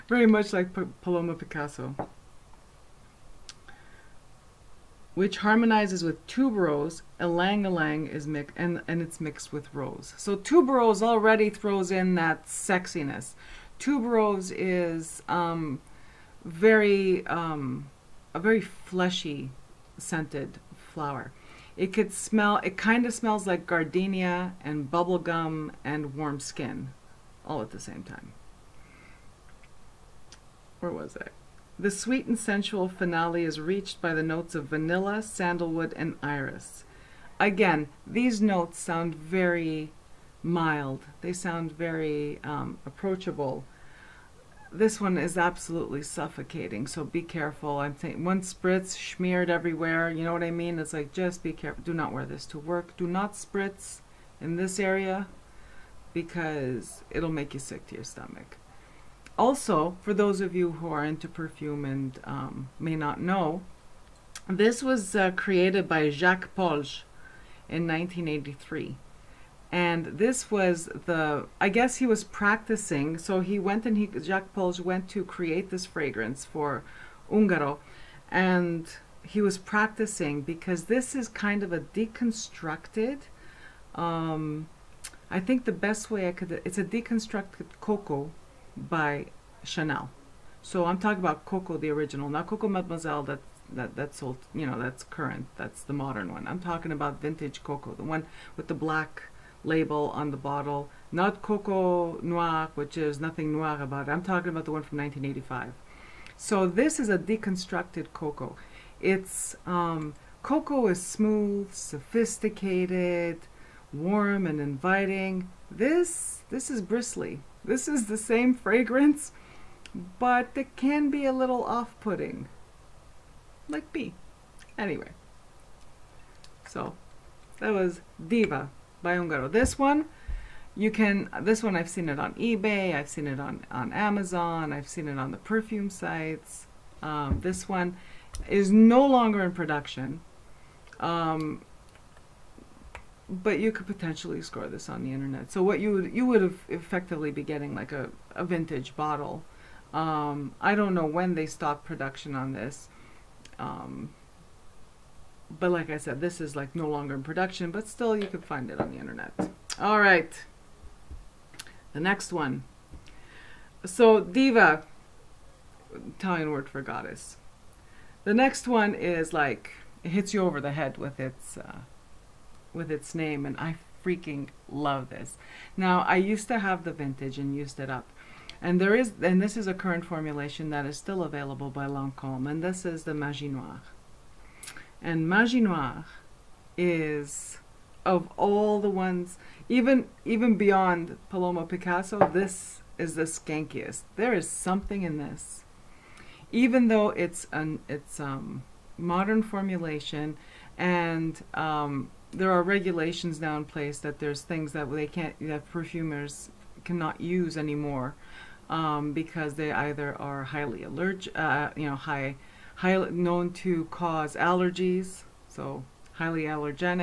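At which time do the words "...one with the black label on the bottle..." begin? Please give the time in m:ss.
1:38.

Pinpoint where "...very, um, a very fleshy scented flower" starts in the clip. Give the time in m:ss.
0:16.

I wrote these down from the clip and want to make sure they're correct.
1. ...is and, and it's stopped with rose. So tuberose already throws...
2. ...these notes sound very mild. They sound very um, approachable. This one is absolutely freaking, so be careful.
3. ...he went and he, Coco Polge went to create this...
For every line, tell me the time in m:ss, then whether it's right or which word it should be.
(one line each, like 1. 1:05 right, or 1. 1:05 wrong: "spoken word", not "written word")
1. 0:08 wrong: "mixed", not "stopped"
2. 0:38 wrong: "suffocating", not "freaking"
3. 1:13 wrong: "Jacques", not "Coco".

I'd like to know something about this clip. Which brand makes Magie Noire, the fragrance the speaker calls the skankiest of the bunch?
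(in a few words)
Lancome.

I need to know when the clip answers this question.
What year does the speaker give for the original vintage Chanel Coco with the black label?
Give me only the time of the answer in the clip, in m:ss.
1:44.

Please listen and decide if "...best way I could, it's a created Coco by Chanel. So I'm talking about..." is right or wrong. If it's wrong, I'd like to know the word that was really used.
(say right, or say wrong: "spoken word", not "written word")
wrong: "deconstructed", not "created".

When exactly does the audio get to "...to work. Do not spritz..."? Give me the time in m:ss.
0:52.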